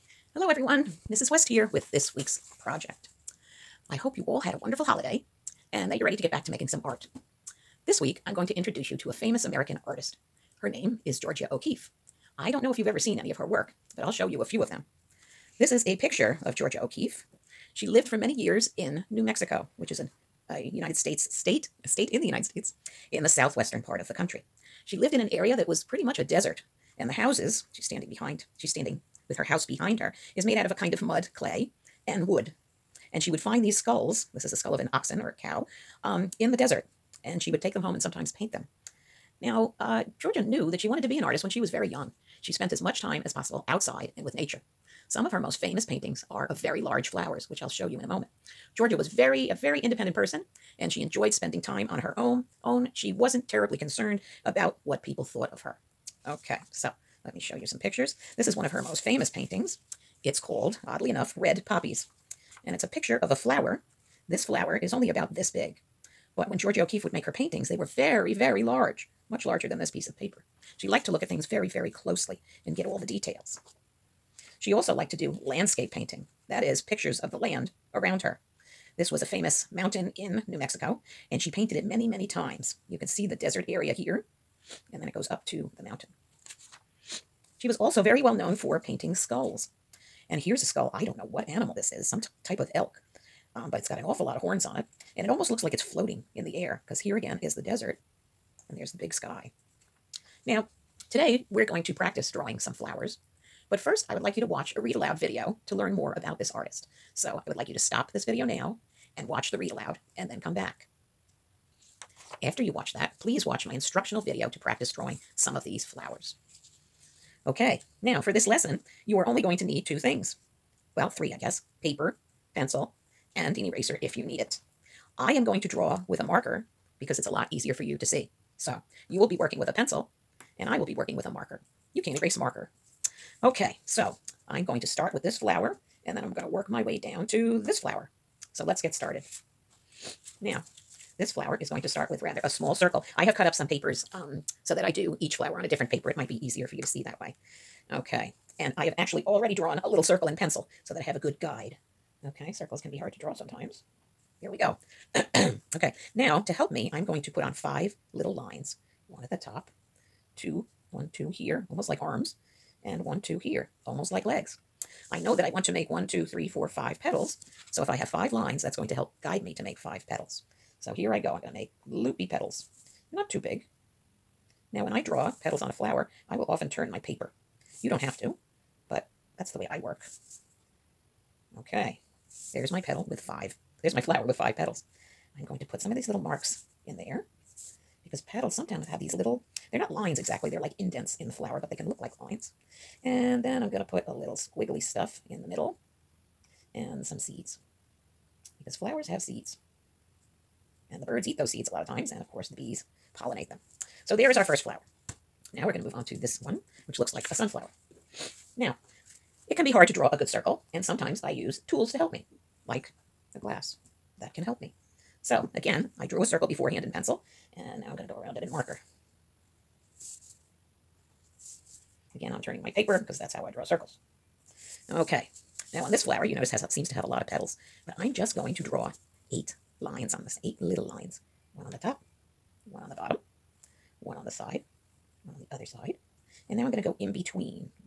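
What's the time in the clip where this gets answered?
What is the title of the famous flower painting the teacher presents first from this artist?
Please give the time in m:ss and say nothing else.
1:01.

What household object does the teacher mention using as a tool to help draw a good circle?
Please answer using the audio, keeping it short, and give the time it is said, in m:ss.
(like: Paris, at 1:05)
A glass, at 3:33.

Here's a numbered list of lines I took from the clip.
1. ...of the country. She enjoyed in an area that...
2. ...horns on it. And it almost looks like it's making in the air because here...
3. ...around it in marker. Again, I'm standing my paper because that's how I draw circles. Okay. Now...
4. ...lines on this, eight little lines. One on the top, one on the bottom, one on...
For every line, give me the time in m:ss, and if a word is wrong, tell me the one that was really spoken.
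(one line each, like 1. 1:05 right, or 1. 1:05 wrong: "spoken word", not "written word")
1. 0:23 wrong: "lived", not "enjoyed"
2. 1:34 wrong: "floating", not "making"
3. 3:38 wrong: "turning", not "standing"
4. 3:49 right.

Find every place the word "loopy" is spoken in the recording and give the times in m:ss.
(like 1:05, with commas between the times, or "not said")
2:51.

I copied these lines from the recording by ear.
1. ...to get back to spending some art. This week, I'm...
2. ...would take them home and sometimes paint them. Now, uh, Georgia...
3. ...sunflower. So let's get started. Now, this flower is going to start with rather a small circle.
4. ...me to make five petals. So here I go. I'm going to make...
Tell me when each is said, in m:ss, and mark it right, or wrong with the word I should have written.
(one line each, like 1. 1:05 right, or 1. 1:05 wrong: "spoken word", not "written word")
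1. 0:06 wrong: "making", not "spending"
2. 0:37 right
3. 2:17 wrong: "flower", not "sunflower"
4. 2:49 right.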